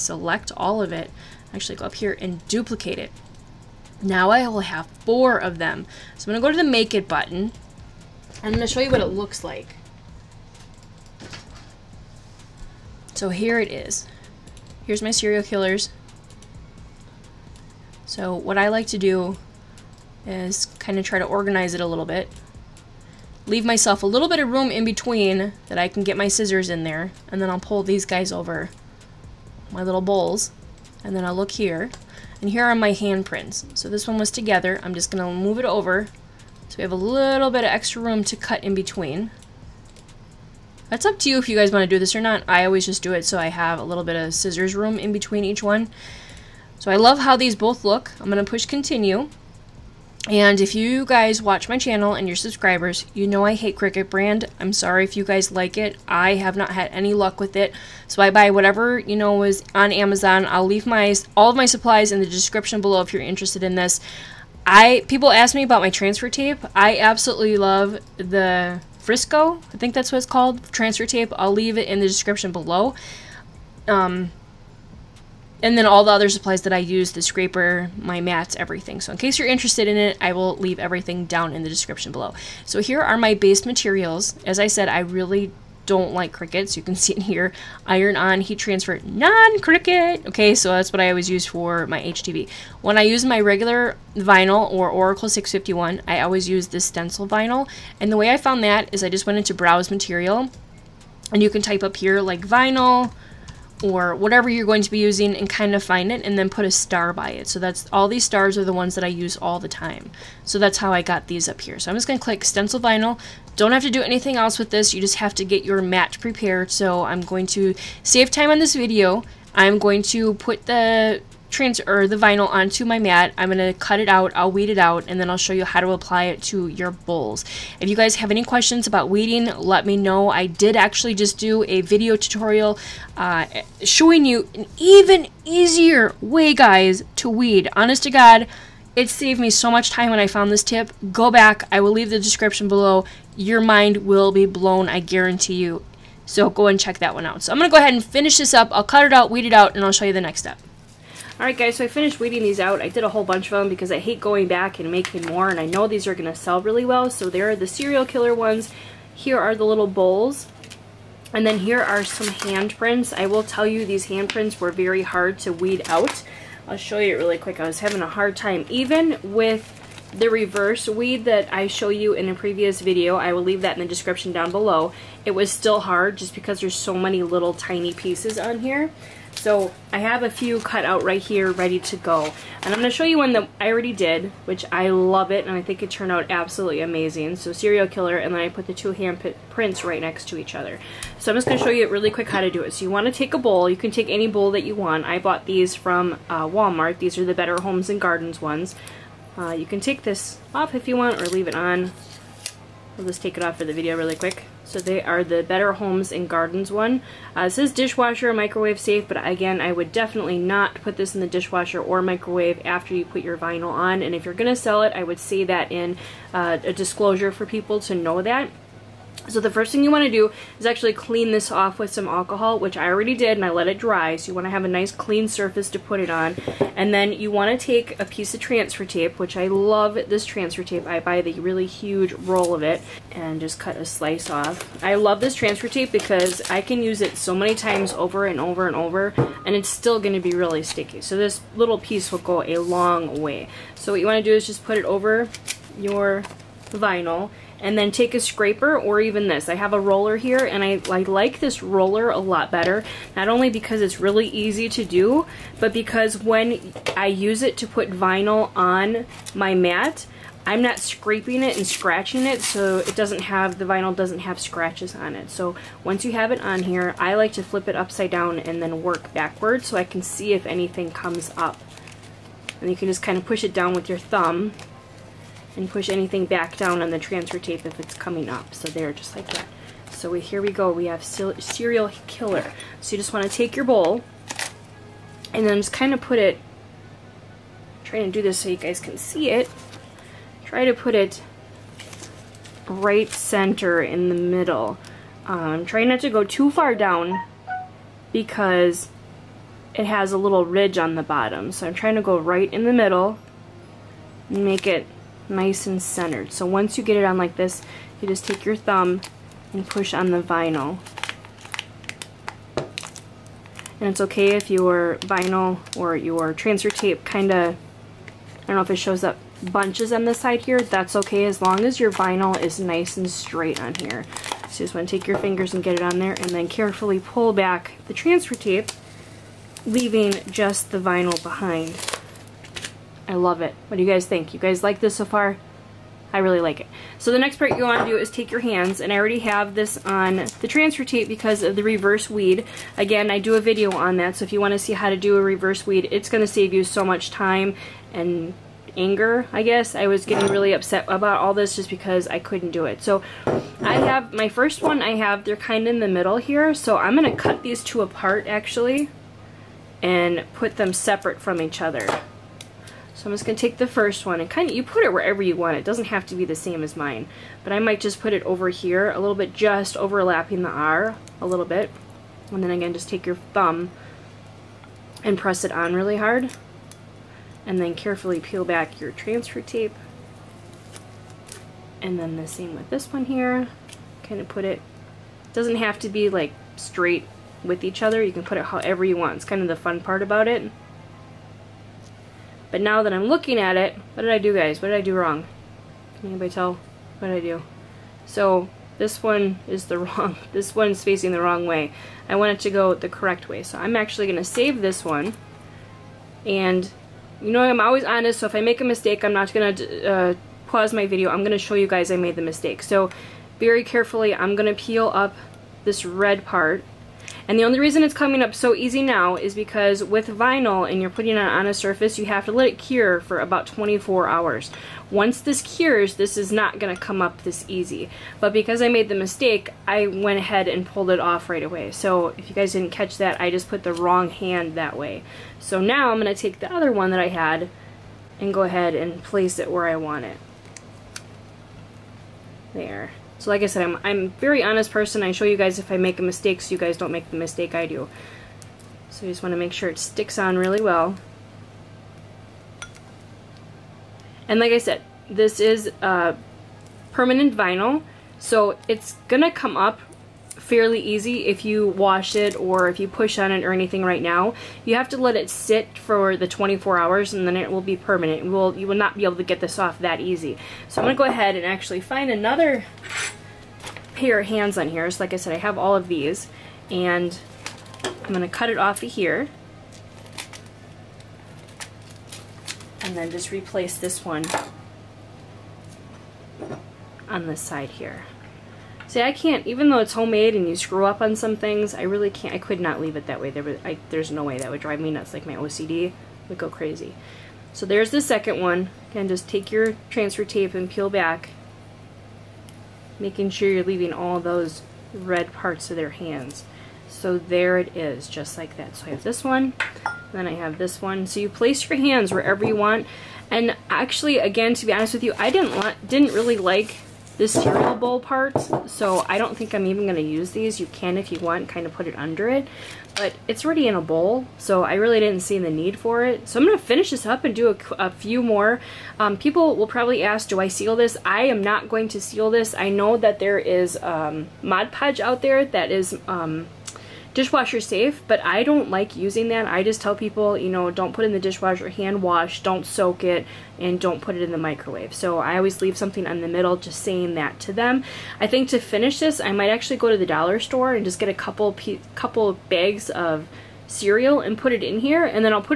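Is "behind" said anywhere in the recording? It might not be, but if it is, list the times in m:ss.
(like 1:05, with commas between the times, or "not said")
5:31.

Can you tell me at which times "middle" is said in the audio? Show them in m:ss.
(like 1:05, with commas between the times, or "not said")
4:54, 5:02, 5:55, 9:06.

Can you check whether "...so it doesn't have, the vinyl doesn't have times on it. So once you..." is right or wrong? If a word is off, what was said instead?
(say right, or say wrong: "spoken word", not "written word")
wrong: "scratches", not "times".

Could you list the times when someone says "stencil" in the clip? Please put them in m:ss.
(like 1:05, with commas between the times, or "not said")
1:36, 1:52.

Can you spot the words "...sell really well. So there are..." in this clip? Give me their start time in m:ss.
2:36.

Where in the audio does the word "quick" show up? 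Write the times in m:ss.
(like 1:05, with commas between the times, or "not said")
2:47, 3:12, 3:24.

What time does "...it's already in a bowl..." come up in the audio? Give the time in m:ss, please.
8:43.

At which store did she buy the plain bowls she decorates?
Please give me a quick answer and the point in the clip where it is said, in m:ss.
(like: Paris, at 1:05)
Walmart, at 3:16.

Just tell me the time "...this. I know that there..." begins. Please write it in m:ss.
8:52.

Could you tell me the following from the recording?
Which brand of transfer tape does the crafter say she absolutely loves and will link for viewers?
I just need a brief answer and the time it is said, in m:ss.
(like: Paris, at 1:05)
Frisco, at 1:08.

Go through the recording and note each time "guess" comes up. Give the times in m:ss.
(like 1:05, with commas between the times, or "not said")
5:49.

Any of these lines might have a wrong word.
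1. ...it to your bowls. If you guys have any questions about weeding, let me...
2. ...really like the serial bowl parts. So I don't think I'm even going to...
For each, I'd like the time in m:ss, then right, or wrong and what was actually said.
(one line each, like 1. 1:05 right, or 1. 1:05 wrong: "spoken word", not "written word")
1. 2:06 right
2. 8:36 wrong: "cereal", not "serial".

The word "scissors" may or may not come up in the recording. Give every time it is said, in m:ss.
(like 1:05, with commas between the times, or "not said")
0:26, 0:44.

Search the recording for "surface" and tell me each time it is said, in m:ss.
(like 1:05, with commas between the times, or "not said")
3:45, 7:01.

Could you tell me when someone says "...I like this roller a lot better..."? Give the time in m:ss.
4:10.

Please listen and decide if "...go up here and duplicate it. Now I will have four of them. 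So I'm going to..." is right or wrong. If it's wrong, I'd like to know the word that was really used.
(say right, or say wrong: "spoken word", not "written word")
right.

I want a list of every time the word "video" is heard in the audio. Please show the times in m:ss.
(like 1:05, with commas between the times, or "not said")
1:58, 2:11, 2:52, 3:23, 5:43, 6:50.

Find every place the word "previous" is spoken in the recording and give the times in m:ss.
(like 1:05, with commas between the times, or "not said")
2:52.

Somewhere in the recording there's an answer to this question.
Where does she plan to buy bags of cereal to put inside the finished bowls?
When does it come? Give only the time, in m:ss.
9:10.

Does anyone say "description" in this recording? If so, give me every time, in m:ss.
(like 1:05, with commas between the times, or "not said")
1:02, 1:12, 1:21, 2:22, 2:53.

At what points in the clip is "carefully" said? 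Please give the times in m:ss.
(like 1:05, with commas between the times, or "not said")
5:26, 6:17, 6:53.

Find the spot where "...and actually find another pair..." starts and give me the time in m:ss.
7:51.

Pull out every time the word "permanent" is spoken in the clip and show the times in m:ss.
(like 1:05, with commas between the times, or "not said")
7:36, 7:47.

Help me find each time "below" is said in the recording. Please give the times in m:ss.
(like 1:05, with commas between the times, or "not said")
1:02, 1:12, 1:22, 2:22, 2:54.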